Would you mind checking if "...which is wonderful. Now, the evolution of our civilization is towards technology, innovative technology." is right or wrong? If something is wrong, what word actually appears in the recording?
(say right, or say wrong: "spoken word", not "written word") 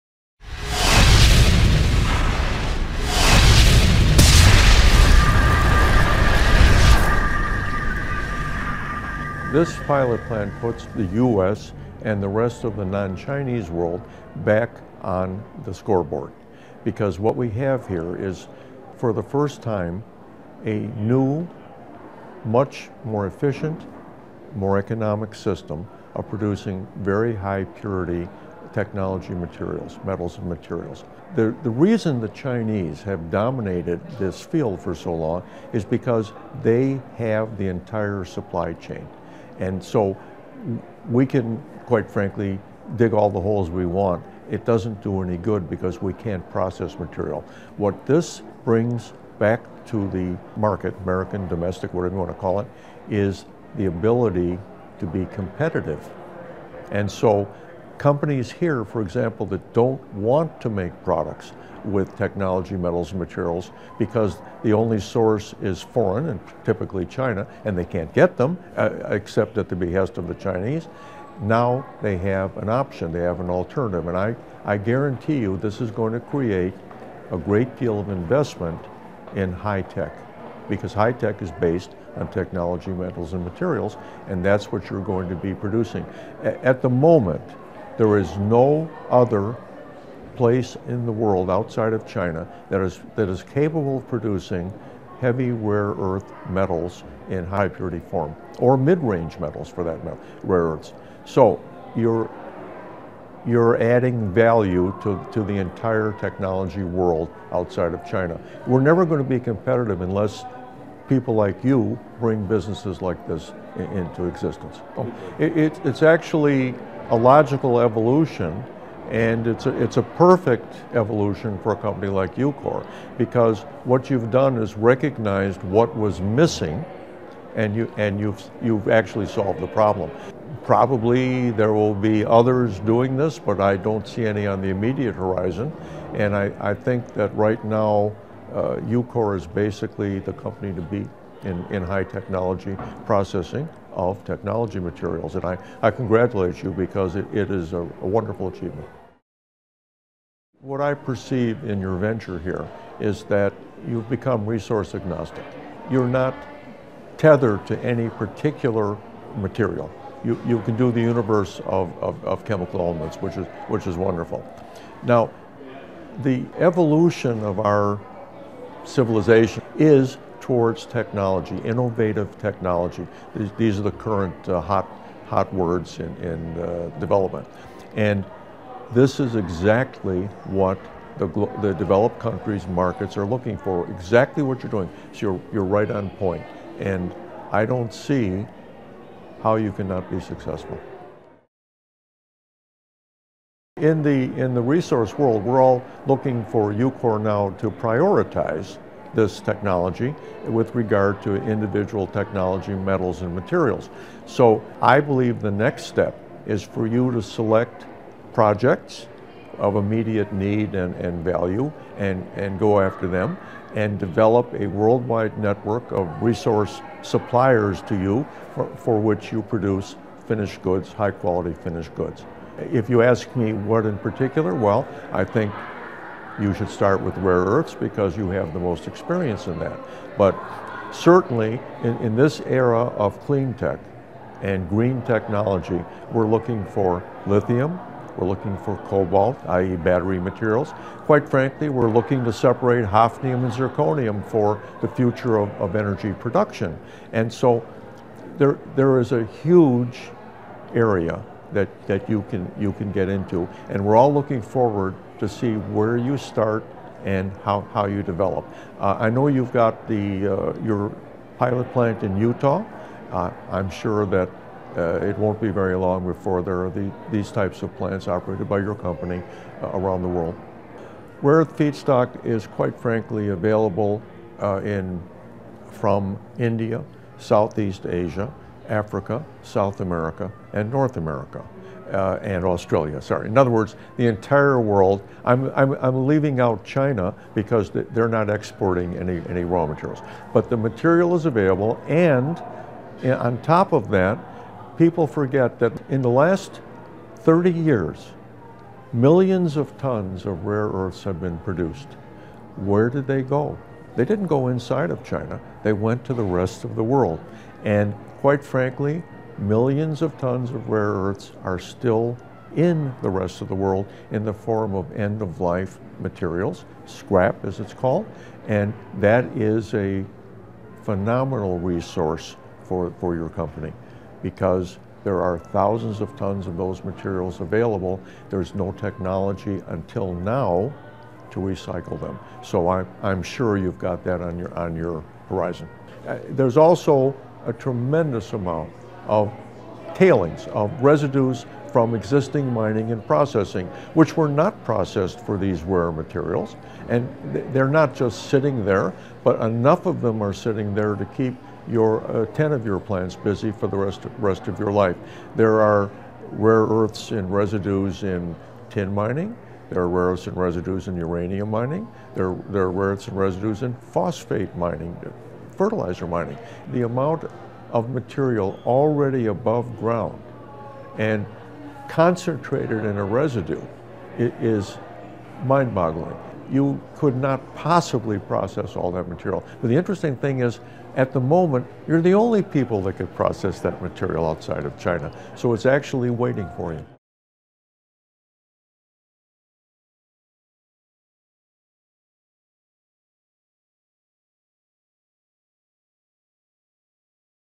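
right.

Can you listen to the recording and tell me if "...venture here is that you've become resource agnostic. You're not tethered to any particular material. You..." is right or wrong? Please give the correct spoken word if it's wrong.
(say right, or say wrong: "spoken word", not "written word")
right.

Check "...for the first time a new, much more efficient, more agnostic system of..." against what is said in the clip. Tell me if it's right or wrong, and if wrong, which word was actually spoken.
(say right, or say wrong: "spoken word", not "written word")
wrong: "economic", not "agnostic".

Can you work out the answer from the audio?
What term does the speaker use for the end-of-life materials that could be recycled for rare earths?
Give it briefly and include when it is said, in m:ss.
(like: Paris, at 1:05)
scrap, at 5:16.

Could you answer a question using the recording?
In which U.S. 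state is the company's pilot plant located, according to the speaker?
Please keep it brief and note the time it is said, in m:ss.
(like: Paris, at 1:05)
Utah, at 4:22.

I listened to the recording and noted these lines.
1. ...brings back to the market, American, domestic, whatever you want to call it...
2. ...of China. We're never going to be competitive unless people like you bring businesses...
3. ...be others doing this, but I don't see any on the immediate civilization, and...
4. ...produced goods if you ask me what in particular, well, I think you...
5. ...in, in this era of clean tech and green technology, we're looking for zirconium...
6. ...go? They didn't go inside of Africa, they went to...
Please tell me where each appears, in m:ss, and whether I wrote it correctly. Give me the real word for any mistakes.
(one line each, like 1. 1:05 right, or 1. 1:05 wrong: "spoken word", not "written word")
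1. 0:48 right
2. 1:47 right
3. 2:11 wrong: "horizon", not "civilization"
4. 3:41 wrong: "finished", not "produced"
5. 3:51 wrong: "lithium", not "zirconium"
6. 5:03 wrong: "China", not "Africa".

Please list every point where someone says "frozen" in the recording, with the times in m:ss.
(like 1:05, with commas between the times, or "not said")
not said.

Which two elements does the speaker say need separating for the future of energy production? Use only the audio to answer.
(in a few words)
hafnium and zirconium.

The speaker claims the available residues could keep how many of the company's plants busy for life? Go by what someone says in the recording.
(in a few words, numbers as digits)
10.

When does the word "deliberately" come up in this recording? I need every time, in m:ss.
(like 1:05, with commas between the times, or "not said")
not said.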